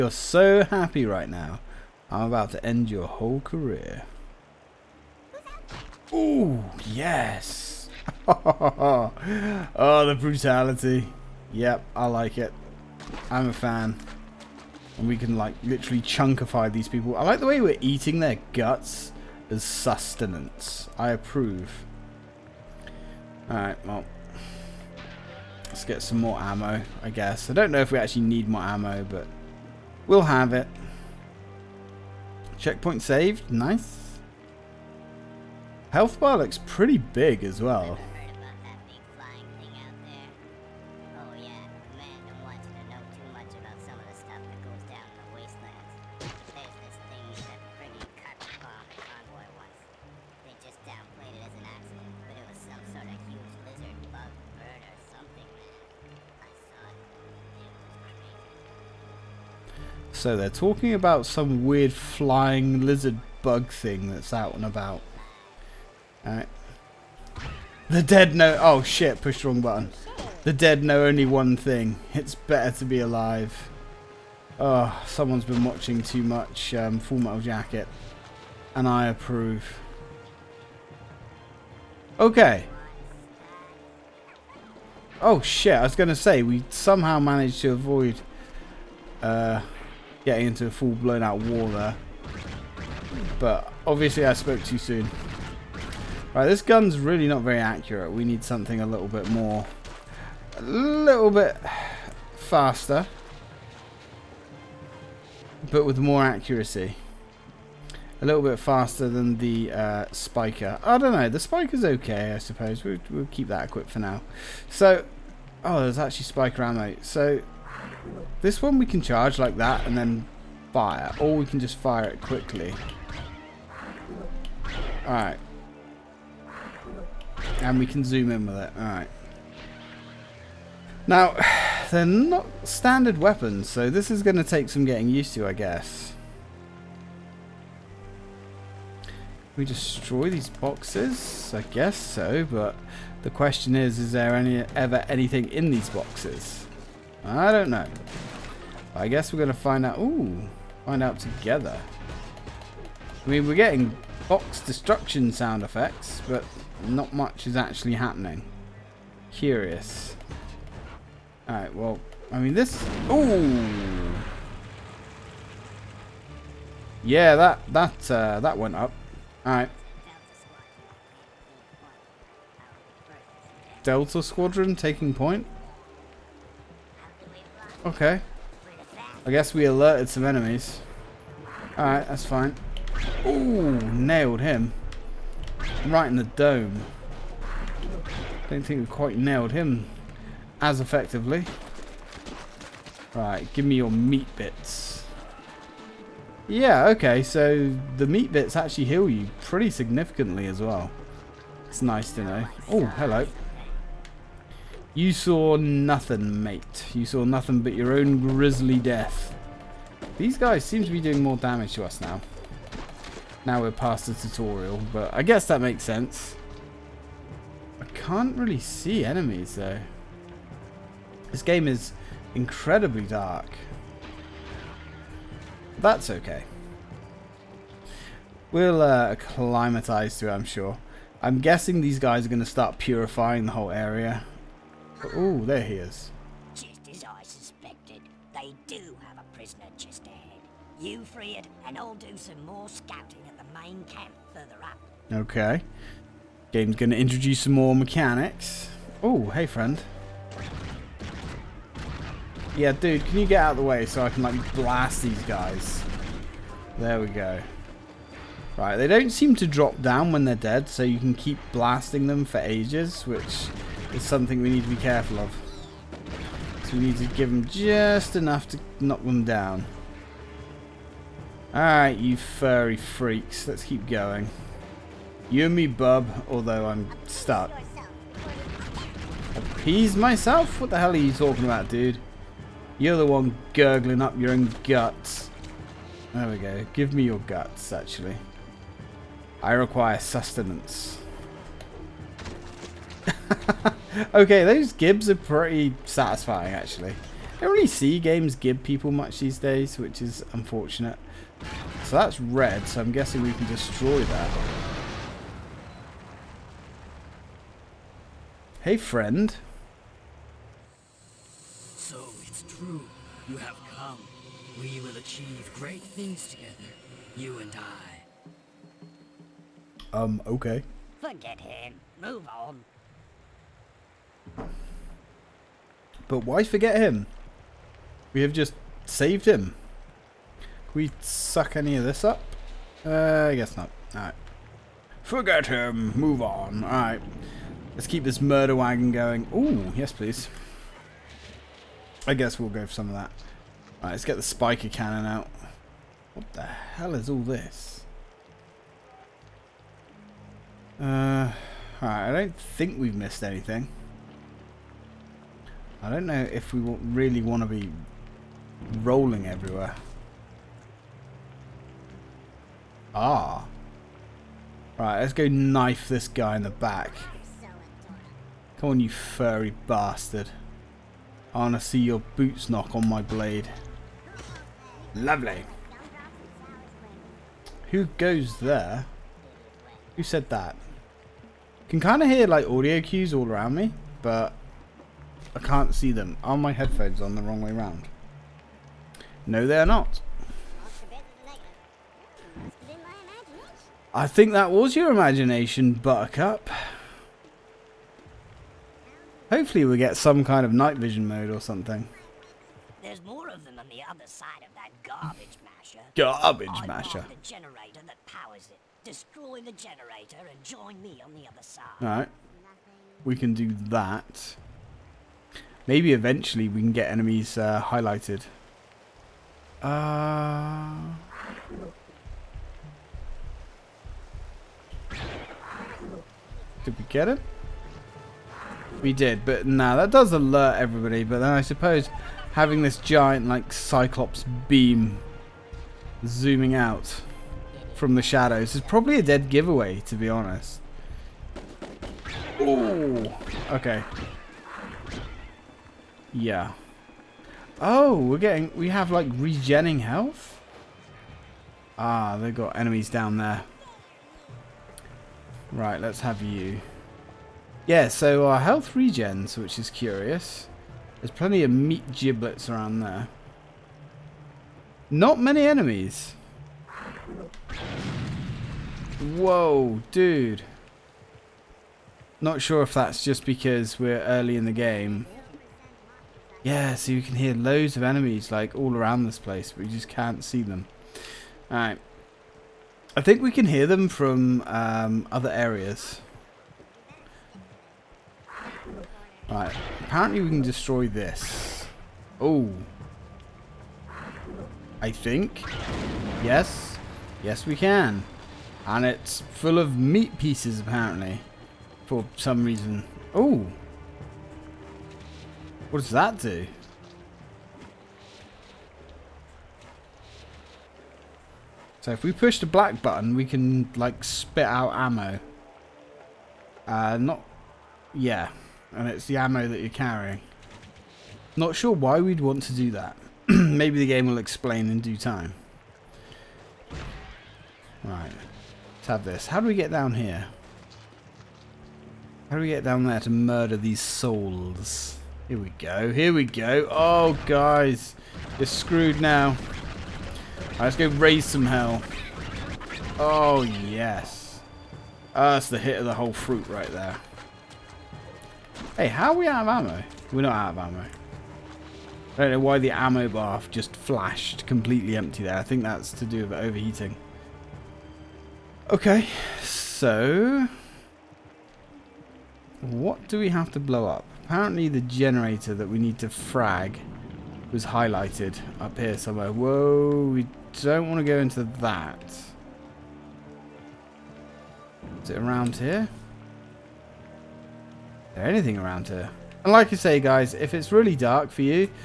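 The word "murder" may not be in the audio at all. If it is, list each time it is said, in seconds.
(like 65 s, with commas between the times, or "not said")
338 s, 533 s.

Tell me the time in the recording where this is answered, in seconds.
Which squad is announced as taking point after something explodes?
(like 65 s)
173 s.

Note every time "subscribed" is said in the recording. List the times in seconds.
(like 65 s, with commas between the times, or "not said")
not said.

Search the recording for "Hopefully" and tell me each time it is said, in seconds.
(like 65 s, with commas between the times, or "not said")
399 s.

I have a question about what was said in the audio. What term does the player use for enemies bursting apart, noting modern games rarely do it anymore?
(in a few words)
gibs.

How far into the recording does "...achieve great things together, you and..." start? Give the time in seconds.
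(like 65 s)
314 s.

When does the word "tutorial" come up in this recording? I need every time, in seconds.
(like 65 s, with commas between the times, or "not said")
214 s.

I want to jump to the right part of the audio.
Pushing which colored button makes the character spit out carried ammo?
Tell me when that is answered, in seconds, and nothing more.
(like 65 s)
512 s.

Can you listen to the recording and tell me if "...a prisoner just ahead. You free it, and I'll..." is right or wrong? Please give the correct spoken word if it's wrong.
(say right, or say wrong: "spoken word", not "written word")
right.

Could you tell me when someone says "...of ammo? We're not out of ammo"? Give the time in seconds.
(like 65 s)
549 s.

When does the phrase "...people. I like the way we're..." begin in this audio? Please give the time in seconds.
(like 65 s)
16 s.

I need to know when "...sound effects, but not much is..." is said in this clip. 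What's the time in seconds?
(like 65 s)
155 s.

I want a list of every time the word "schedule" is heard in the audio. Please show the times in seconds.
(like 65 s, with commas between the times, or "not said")
not said.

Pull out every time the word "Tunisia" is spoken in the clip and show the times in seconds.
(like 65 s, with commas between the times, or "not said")
not said.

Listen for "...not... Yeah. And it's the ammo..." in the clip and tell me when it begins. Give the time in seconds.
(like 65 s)
516 s.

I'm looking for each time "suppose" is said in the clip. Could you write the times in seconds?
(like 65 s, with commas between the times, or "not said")
112 s, 431 s.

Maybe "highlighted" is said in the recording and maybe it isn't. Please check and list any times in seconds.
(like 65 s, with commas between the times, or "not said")
417 s, 567 s.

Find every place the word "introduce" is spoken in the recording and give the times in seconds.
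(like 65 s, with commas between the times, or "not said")
246 s.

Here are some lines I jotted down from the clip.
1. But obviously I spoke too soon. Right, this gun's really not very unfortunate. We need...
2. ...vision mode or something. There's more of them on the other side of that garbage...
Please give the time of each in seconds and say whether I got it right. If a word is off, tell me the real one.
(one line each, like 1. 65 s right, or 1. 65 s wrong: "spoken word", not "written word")
1. 93 s wrong: "accurate", not "unfortunate"
2. 400 s right.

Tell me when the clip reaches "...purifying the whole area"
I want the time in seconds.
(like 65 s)
232 s.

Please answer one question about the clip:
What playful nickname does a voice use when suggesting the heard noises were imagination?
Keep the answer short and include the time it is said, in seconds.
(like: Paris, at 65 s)
Buttercup, at 395 s.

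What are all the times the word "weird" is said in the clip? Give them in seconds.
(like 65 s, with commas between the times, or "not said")
61 s.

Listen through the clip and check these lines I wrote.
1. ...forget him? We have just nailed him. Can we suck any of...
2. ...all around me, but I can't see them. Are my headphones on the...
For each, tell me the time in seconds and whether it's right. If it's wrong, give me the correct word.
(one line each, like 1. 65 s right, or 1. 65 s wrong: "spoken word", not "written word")
1. 326 s wrong: "saved", not "nailed"
2. 383 s right.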